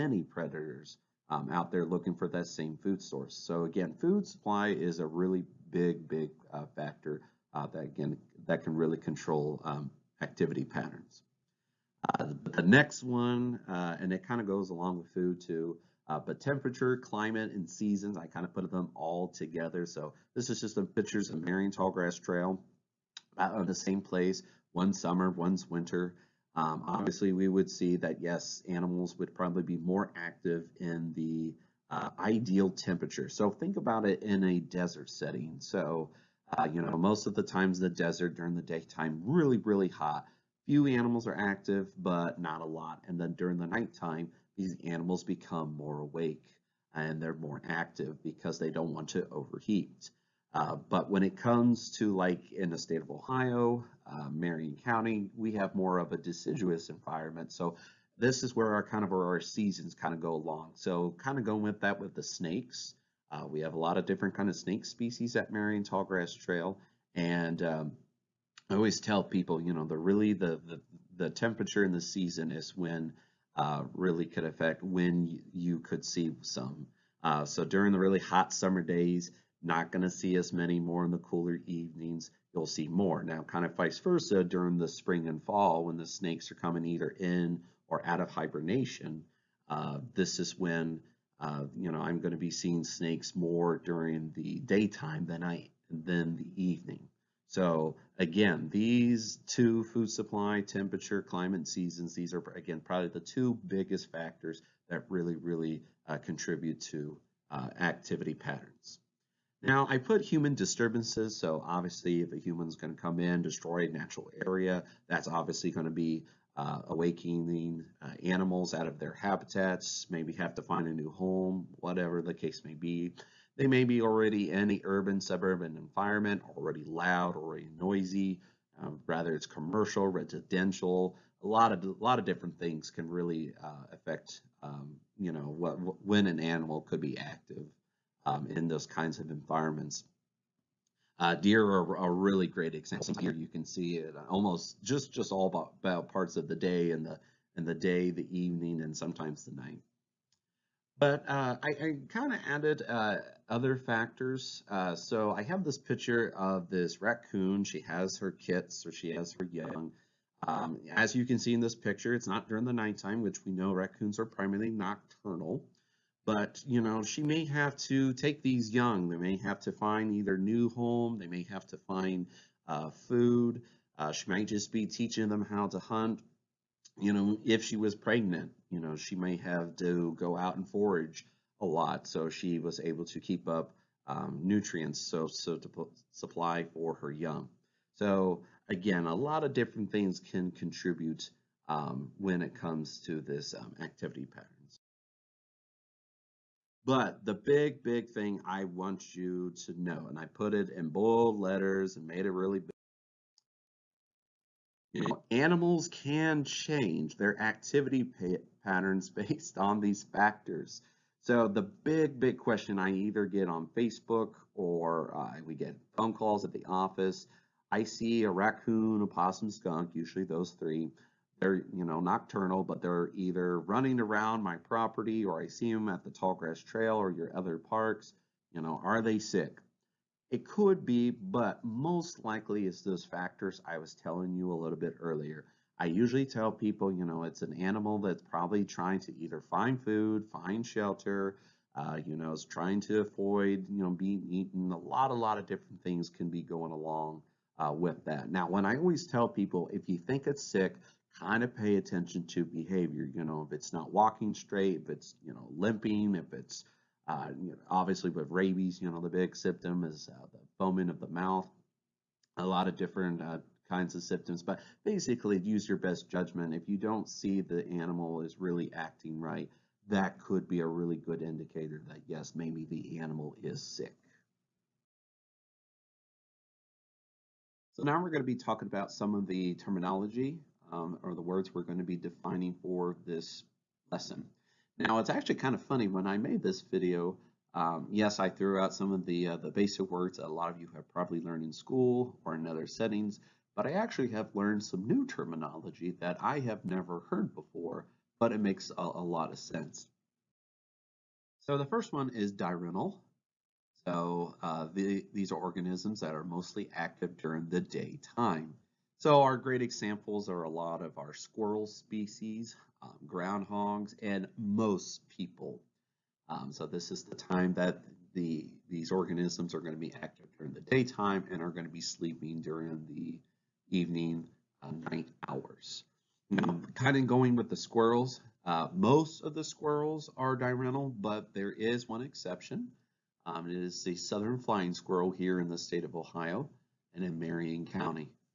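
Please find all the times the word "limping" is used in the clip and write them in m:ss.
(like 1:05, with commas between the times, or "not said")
4:15.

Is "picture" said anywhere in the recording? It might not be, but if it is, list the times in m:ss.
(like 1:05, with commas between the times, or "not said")
0:20, 2:35, 2:41.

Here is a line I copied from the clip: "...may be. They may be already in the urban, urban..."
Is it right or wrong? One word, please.
wrong.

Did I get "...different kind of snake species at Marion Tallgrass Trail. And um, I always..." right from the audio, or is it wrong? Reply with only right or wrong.
right.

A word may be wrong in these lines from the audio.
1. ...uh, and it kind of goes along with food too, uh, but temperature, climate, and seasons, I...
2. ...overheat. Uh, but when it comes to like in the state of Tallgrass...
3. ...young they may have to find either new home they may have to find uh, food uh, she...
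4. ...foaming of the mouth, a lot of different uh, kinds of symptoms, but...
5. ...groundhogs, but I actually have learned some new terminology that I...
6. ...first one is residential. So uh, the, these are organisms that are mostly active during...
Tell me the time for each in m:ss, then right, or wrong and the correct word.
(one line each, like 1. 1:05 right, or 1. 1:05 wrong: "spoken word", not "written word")
1. 0:13 right
2. 0:49 wrong: "Ohio", not "Tallgrass"
3. 2:48 right
4. 4:20 right
5. 4:52 wrong: "settings", not "groundhogs"
6. 5:01 wrong: "diurnal", not "residential".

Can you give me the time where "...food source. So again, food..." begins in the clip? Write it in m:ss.
0:02.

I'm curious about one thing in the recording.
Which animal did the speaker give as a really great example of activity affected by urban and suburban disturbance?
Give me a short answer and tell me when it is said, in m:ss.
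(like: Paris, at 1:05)
Deer, at 2:21.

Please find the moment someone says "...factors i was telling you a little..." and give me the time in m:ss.
3:53.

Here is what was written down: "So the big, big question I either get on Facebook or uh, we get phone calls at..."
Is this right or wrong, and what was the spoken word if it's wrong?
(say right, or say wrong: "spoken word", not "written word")
right.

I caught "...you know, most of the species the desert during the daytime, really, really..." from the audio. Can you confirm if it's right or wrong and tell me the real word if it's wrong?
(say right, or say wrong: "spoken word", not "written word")
wrong: "times", not "species".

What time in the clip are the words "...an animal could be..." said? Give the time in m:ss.
2:16.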